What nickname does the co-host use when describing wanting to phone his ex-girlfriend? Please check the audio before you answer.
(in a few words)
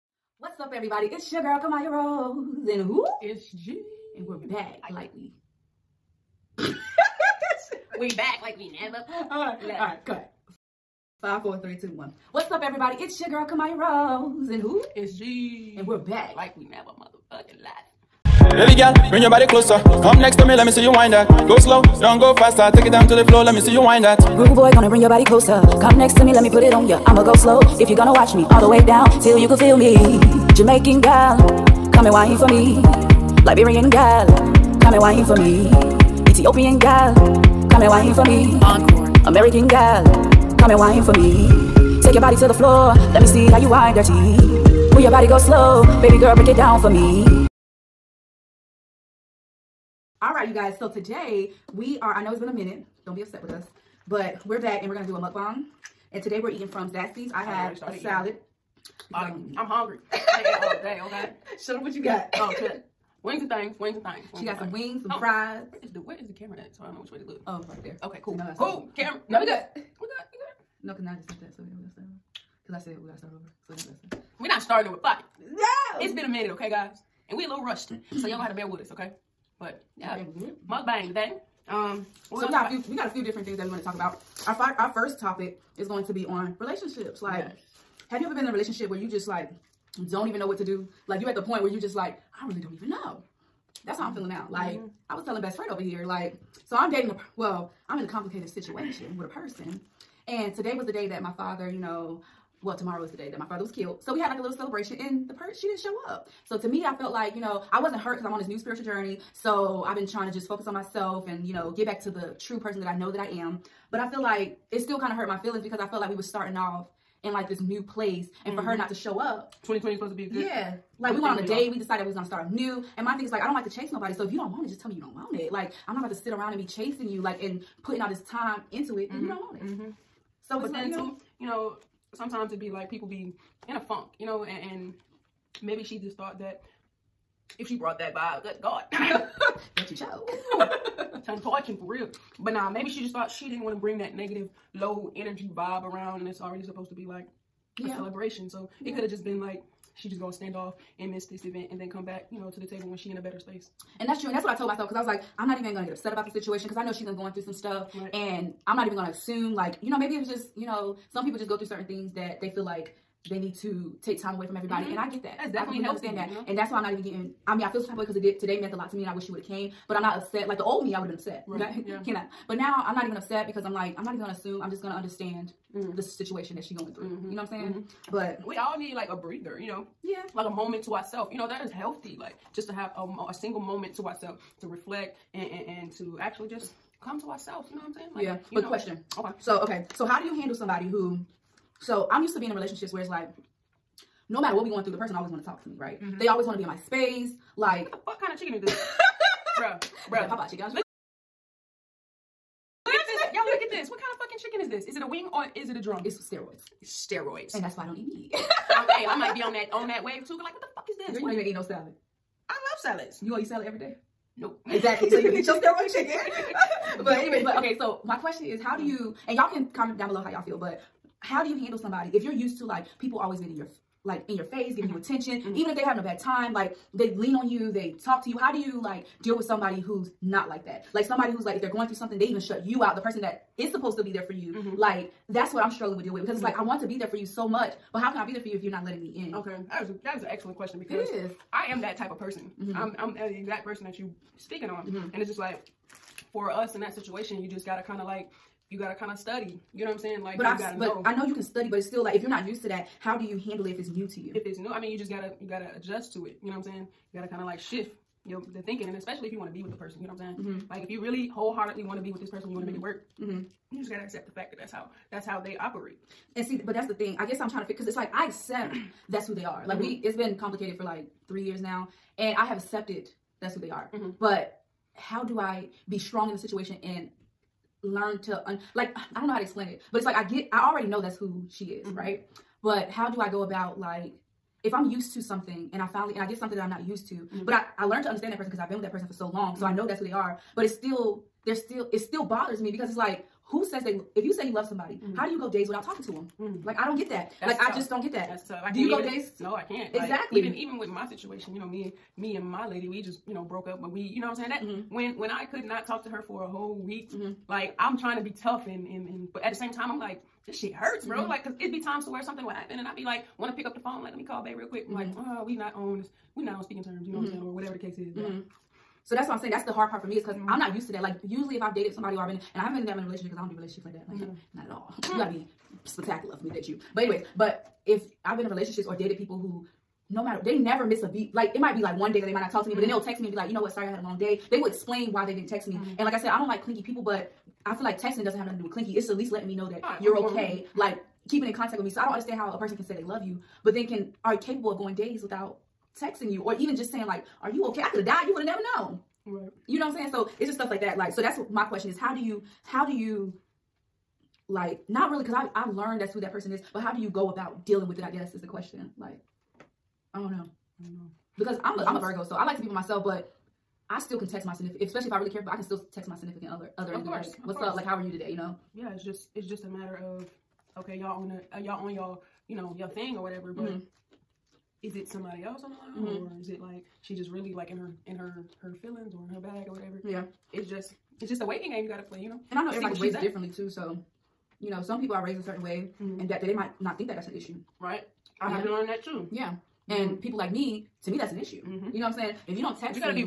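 Bay.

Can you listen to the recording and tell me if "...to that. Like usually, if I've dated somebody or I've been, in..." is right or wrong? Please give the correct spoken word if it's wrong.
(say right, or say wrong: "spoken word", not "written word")
right.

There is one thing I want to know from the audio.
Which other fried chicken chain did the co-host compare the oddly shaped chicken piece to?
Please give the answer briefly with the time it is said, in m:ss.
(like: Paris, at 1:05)
Popeye, at 3:20.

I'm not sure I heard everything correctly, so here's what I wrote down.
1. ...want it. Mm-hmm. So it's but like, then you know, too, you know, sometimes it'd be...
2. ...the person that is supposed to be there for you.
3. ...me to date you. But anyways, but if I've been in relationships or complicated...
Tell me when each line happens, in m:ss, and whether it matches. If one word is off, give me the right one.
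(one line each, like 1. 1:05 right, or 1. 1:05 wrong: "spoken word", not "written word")
1. 2:09 right
2. 3:52 right
3. 5:26 wrong: "dated", not "complicated".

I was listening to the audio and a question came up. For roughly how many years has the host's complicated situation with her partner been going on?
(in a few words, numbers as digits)
3.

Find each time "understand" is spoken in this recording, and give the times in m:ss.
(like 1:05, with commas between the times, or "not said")
2:45, 2:54, 4:48, 5:42.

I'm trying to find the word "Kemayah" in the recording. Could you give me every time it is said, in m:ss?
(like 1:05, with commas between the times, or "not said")
0:01, 0:13.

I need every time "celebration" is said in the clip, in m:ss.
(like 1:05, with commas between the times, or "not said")
1:44, 2:27.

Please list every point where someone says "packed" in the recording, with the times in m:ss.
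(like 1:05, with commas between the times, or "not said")
not said.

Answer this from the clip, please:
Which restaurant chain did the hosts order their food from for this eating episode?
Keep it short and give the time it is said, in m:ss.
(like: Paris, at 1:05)
Zaxby's, at 0:56.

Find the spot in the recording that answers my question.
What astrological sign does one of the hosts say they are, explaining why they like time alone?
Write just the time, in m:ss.
6:01.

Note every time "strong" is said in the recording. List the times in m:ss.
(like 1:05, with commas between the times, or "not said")
4:35.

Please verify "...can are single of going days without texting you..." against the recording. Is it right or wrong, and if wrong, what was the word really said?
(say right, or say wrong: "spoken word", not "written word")
wrong: "capable", not "single".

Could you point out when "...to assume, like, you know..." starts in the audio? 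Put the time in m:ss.
2:39.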